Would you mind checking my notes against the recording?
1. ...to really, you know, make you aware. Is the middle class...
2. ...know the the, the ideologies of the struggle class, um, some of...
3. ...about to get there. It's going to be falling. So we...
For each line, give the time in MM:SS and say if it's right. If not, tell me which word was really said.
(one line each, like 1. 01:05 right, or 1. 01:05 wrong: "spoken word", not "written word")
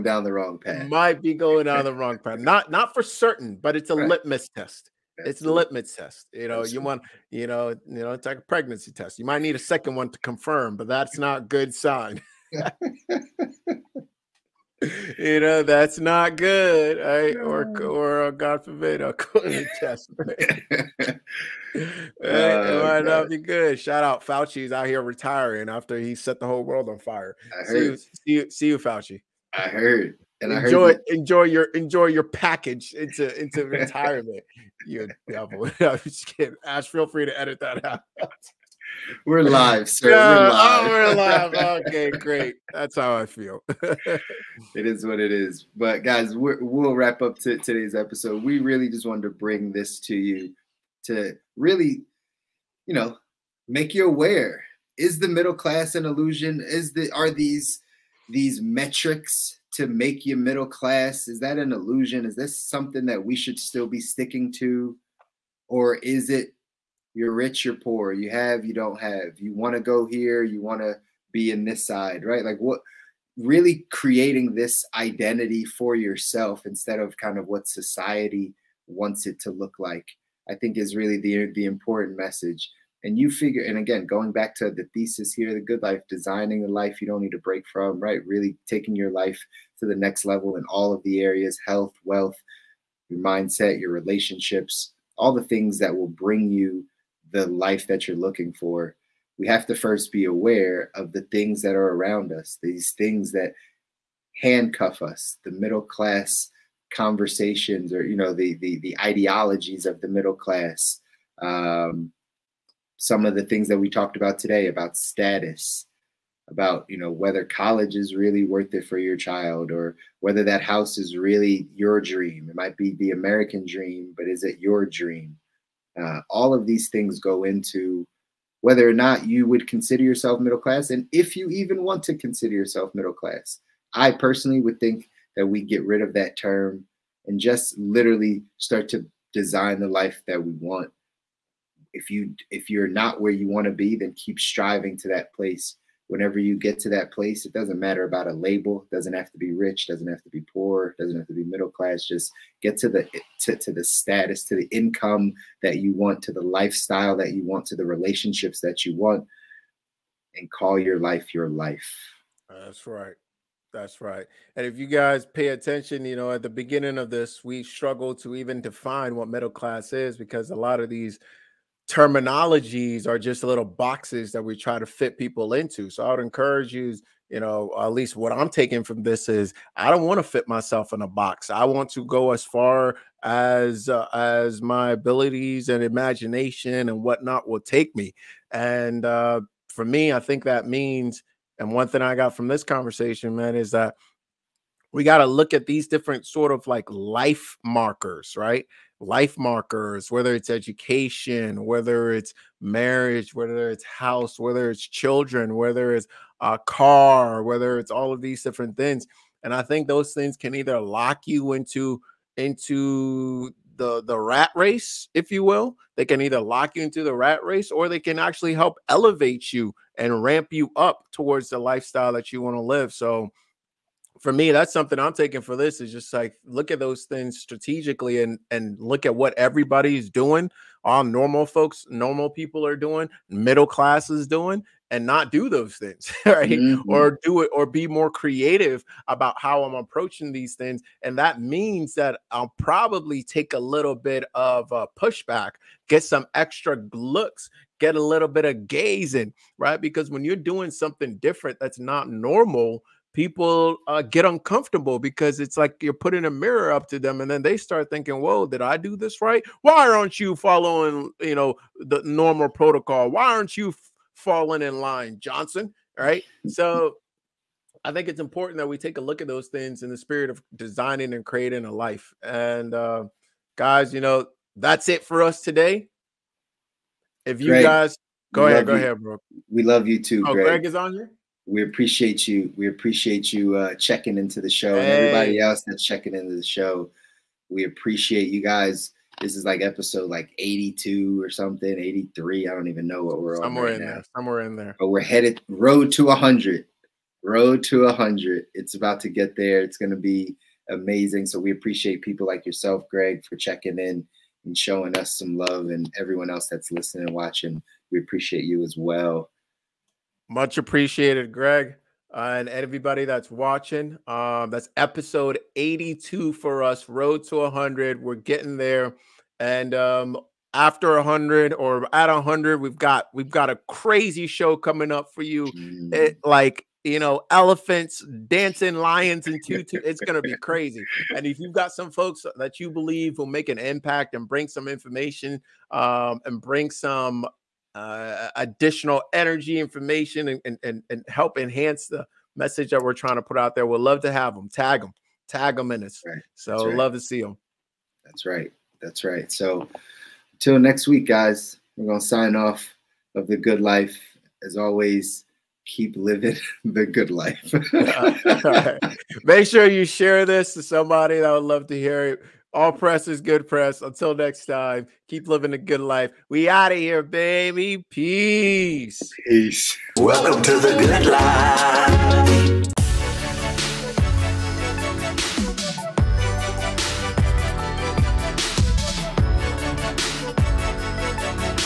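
1. 00:51 right
2. 01:48 wrong: "middle", not "struggle"
3. 04:58 wrong: "amazing", not "falling".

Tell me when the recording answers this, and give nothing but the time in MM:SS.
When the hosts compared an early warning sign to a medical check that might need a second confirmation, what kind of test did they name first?
00:08.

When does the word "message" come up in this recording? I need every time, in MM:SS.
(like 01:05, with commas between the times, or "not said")
01:22, 05:42.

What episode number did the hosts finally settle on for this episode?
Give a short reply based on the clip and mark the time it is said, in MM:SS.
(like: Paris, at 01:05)
82, at 05:14.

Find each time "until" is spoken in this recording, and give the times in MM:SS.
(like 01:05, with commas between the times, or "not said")
05:50, 06:03.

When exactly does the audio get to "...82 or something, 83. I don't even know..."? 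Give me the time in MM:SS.
04:50.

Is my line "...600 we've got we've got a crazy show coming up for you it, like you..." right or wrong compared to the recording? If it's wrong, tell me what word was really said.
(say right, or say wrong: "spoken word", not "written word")
wrong: "100", not "600".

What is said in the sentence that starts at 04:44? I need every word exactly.
and everybody else that's checking into the show.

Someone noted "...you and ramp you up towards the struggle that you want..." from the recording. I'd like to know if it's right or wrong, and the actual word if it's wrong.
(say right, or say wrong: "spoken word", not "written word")
wrong: "lifestyle", not "struggle".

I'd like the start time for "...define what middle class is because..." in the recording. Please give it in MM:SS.
02:48.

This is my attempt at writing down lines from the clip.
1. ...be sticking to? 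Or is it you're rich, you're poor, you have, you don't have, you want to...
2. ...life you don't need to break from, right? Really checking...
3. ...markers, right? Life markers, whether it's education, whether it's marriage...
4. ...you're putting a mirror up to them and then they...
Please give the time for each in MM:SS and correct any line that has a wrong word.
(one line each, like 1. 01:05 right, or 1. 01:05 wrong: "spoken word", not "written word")
1. 01:03 right
2. 01:26 wrong: "taking", not "checking"
3. 03:17 right
4. 04:15 right.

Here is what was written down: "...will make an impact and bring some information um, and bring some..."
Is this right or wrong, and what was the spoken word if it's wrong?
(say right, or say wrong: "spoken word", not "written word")
right.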